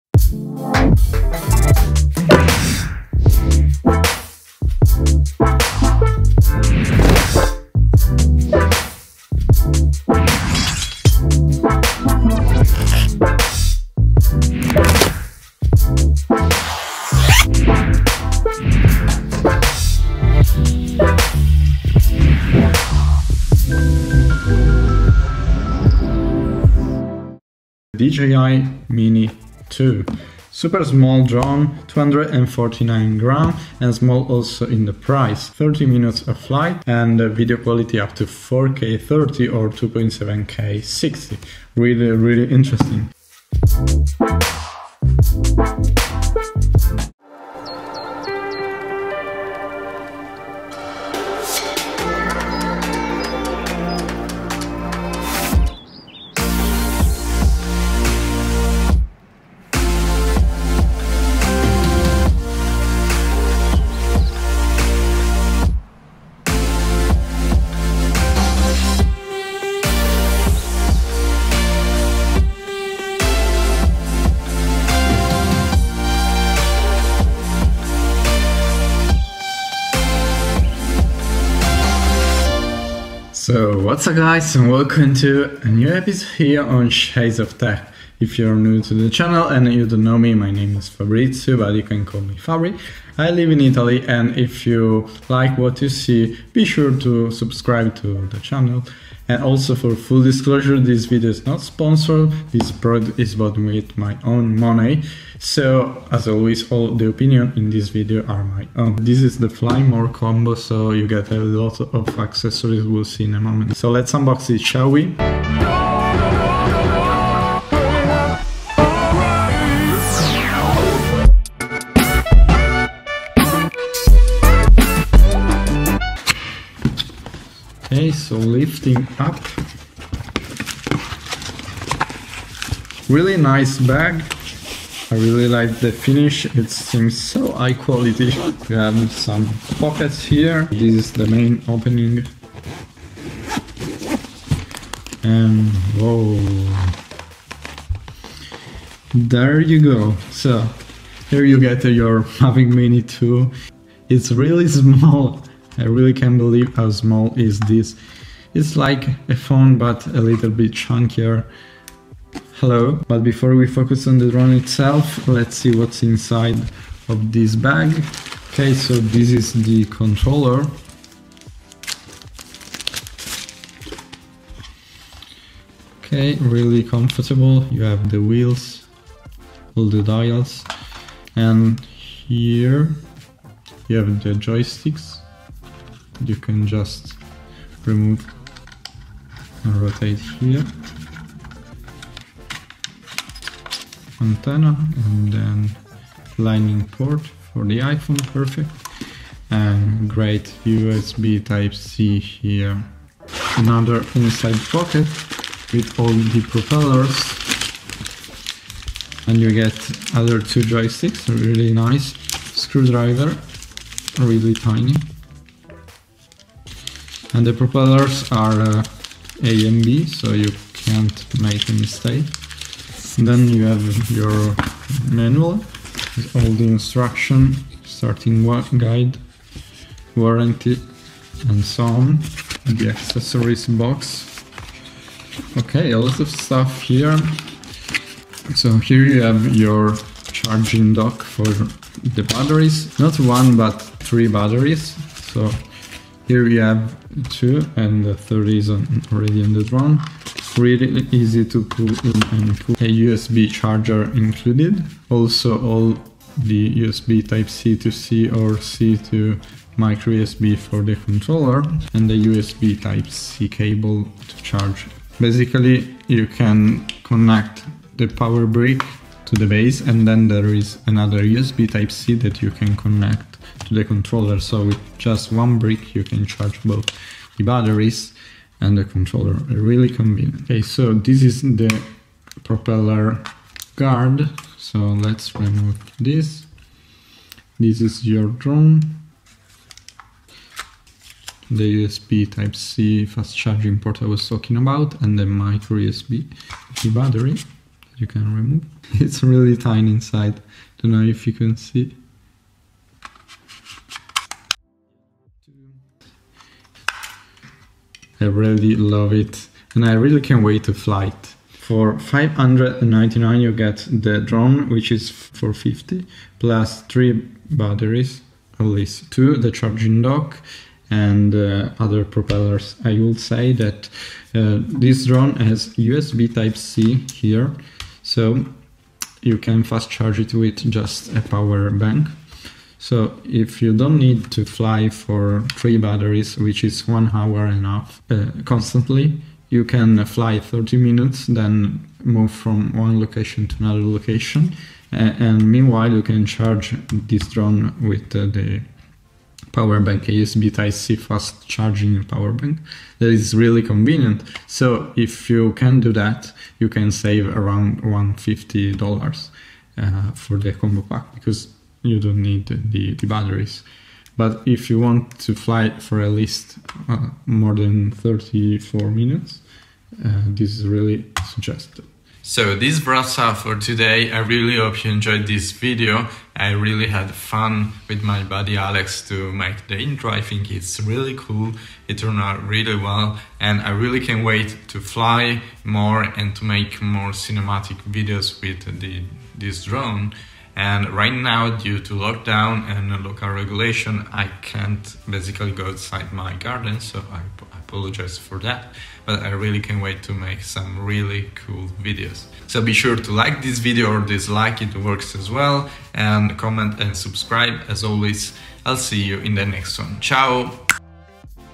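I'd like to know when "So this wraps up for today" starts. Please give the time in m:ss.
6:12.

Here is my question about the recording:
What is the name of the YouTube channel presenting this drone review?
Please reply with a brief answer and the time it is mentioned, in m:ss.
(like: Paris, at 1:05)
Shades of Tech, at 1:26.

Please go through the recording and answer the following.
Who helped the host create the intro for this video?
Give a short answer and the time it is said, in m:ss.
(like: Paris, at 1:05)
Alex, at 6:18.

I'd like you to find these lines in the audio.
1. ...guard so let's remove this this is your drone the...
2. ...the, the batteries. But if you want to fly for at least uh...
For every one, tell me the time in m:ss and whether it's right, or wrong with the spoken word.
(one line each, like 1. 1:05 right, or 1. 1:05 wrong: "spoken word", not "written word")
1. 4:43 right
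2. 6:02 right.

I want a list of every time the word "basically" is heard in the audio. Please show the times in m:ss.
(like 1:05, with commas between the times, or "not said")
4:25, 6:35.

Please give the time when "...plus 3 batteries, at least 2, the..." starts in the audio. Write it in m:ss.
5:16.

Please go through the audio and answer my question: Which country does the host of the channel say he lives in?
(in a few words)
Italy.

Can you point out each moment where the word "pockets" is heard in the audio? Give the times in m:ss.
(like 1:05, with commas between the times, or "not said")
2:19, 3:24.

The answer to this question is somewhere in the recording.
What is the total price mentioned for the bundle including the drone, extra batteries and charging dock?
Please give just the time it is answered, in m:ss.
5:11.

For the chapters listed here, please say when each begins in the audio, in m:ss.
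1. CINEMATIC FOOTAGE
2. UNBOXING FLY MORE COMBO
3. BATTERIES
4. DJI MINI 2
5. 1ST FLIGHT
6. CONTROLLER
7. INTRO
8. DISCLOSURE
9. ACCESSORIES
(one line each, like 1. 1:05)
1. 1:55
2. 2:06
3. 3:58
4. 2:27
5. 0:47
6. 2:46
7. 0:27
8. 1:23
9. 3:23.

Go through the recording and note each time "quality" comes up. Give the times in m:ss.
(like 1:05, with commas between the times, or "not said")
0:37, 2:17.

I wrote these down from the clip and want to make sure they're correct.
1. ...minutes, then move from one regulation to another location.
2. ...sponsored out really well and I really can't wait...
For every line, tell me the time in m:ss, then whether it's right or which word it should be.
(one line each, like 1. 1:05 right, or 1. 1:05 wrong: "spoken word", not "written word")
1. 5:40 wrong: "location", not "regulation"
2. 6:21 wrong: "turned", not "sponsored".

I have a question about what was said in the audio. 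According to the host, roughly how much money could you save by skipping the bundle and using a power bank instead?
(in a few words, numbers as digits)
$150.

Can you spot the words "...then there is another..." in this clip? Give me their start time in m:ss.
4:30.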